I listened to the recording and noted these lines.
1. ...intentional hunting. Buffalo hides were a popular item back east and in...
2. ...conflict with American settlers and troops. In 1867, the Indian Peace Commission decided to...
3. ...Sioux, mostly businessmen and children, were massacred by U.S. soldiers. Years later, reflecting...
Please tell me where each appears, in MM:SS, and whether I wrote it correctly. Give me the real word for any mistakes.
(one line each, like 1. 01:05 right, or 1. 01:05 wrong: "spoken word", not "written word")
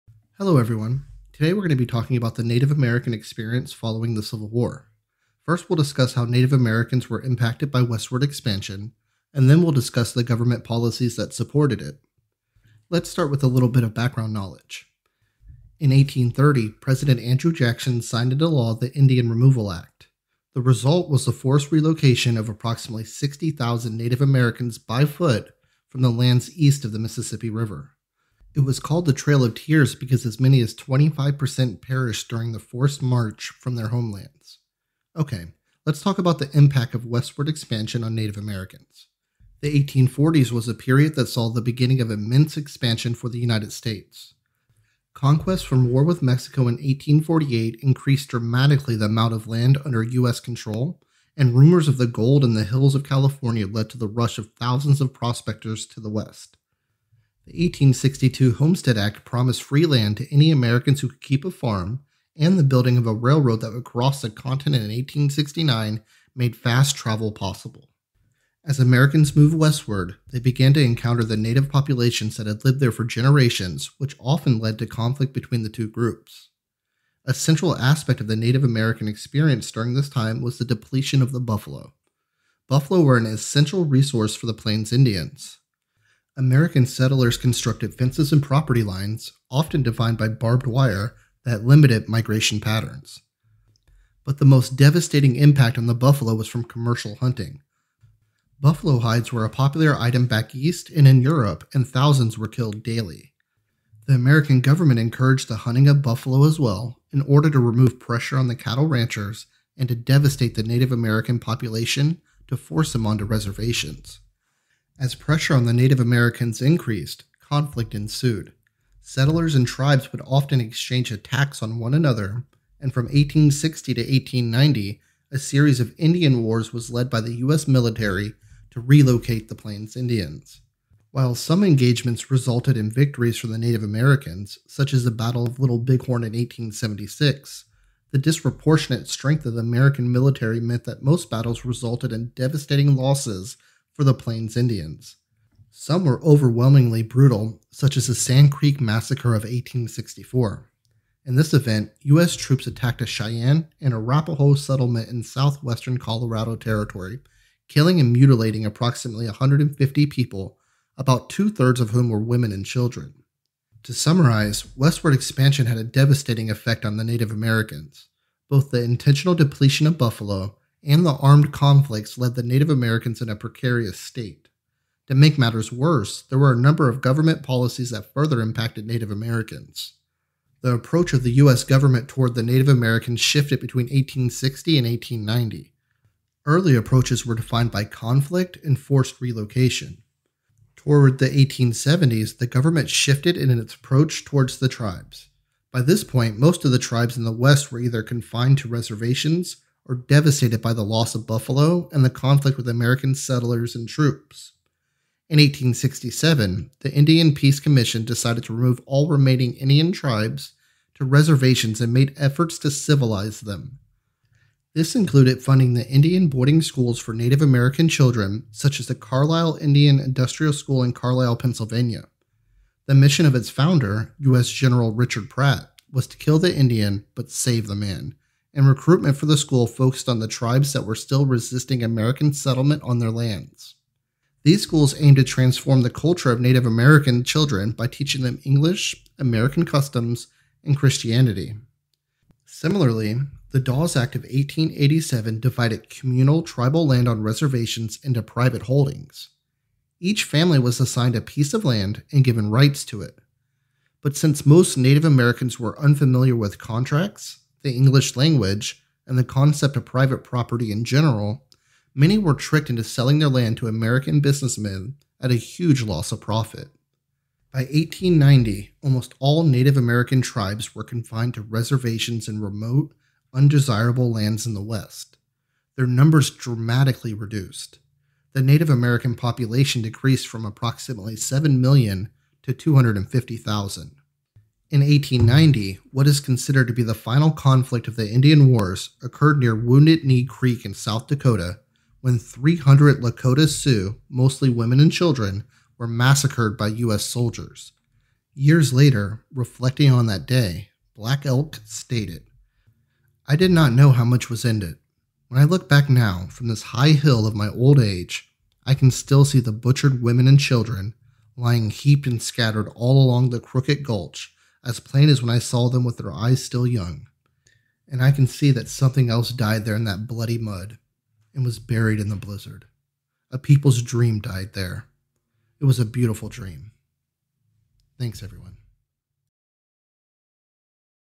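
1. 01:36 wrong: "commercial", not "intentional"
2. 03:22 right
3. 04:53 wrong: "women", not "businessmen".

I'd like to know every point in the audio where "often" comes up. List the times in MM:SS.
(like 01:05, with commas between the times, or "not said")
01:14, 01:29, 02:00.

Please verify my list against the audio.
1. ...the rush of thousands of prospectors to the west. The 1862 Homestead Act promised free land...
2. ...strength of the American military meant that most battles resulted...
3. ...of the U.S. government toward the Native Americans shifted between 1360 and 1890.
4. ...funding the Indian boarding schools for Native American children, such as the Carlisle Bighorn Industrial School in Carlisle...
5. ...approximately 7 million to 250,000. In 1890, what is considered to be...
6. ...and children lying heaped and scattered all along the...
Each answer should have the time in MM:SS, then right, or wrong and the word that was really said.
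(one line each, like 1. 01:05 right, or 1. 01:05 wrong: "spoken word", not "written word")
1. 00:53 right
2. 02:19 right
3. 03:01 wrong: "1860", not "1360"
4. 03:35 wrong: "Indian", not "Bighorn"
5. 04:40 right
6. 05:10 right.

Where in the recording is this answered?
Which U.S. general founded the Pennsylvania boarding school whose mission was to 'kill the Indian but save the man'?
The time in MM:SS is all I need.
03:44.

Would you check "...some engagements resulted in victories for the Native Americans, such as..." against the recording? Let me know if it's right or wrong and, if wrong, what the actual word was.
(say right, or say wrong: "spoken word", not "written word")
right.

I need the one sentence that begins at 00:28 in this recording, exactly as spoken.
It was called the Trail of Tears because as many as 25% perished during the forced march from their homelands.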